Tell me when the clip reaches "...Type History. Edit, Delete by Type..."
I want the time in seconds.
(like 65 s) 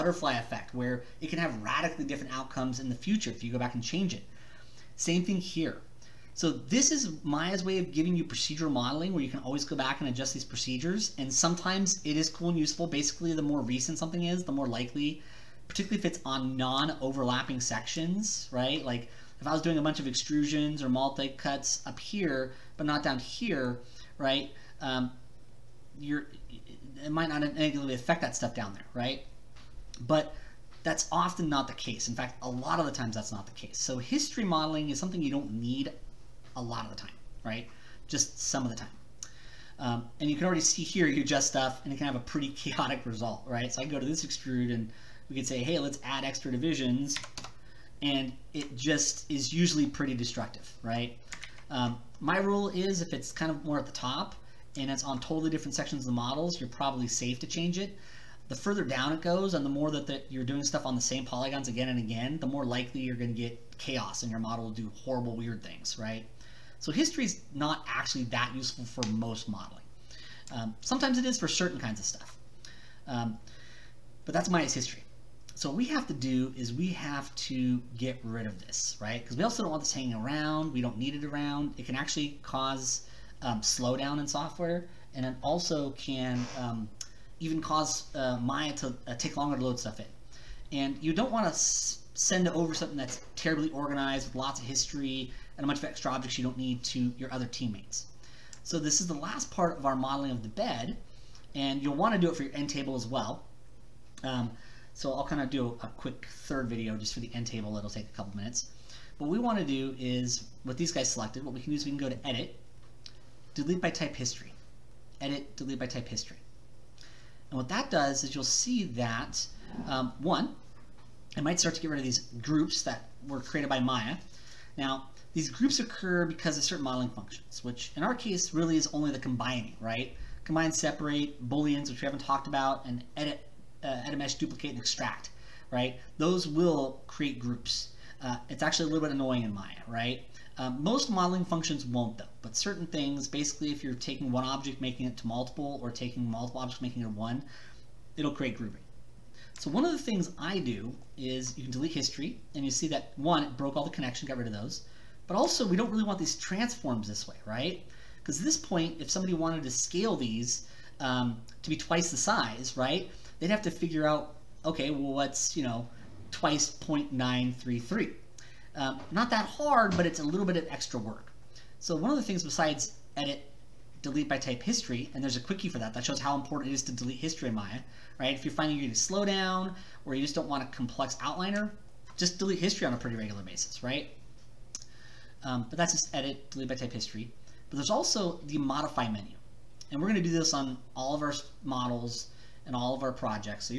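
113 s.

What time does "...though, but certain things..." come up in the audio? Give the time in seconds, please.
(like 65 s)
142 s.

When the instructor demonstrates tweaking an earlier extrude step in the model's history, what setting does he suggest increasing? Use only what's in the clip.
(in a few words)
Divisions.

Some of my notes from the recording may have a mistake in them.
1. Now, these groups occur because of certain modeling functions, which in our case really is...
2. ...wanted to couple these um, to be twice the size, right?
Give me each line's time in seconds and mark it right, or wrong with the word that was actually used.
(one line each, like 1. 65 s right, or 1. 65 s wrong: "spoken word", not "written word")
1. 124 s right
2. 159 s wrong: "scale", not "couple".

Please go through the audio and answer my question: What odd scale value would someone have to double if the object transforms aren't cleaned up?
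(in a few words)
0.933.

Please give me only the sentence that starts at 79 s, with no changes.
Because we also don't want this hanging around.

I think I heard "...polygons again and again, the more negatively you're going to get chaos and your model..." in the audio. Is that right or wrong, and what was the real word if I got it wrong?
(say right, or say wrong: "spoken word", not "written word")
wrong: "likely", not "negatively".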